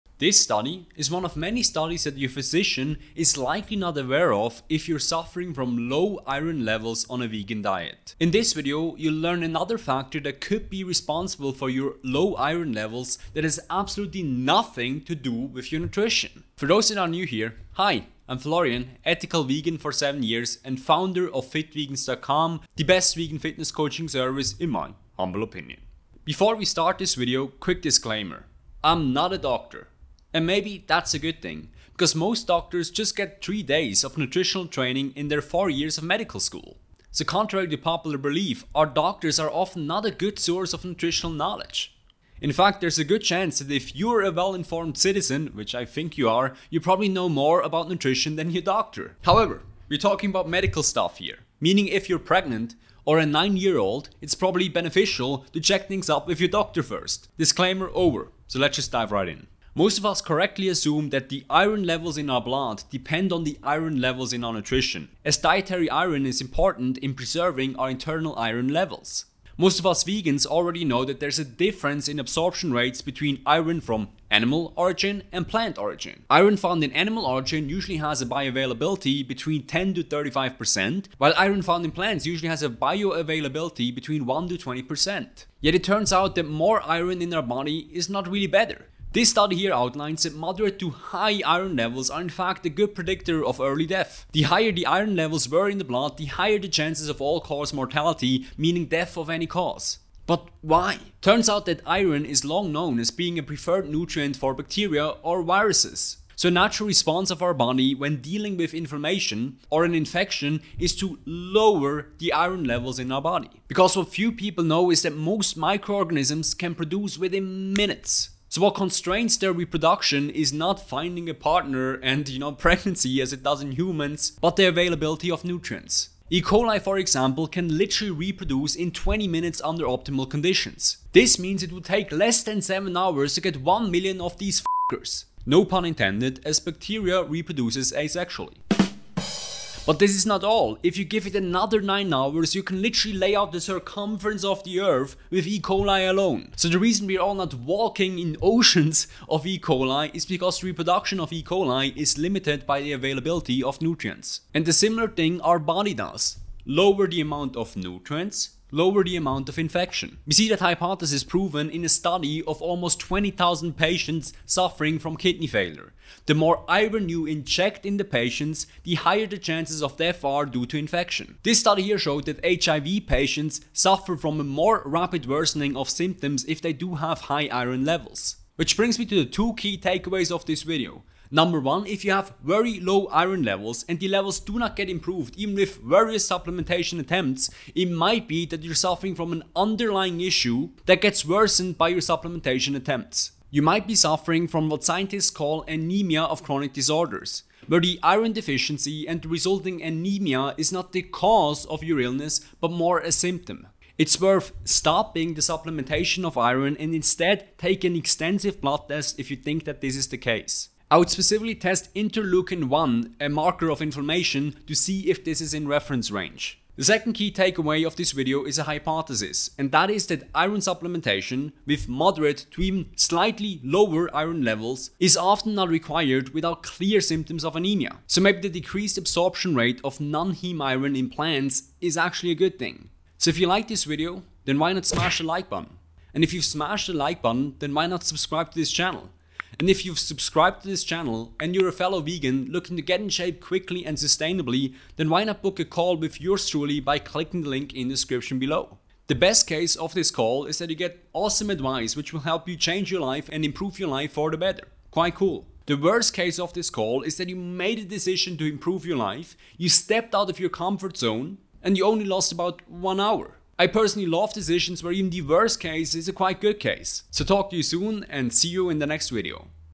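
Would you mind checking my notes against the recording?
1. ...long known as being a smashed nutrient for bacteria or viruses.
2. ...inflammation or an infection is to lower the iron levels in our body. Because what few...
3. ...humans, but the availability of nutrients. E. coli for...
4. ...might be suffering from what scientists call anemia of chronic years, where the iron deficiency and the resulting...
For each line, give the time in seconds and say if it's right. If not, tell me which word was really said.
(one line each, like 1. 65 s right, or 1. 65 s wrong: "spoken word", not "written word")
1. 102 s wrong: "preferred", not "smashed"
2. 108 s right
3. 123 s right
4. 193 s wrong: "disorders", not "years".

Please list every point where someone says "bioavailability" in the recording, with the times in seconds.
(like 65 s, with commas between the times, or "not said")
78 s, 82 s.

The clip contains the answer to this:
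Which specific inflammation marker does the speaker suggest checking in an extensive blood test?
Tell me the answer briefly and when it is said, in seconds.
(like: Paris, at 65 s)
interleukin 1, at 211 s.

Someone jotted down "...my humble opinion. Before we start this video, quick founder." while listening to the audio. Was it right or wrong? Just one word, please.
wrong.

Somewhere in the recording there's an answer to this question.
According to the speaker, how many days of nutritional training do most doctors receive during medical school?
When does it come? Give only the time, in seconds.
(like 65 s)
33 s.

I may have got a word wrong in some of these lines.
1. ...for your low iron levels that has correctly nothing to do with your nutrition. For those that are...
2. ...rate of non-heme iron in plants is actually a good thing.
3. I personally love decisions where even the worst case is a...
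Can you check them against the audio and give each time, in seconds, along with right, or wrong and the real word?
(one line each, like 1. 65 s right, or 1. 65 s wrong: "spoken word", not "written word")
1. 11 s wrong: "absolutely", not "correctly"
2. 229 s right
3. 263 s right.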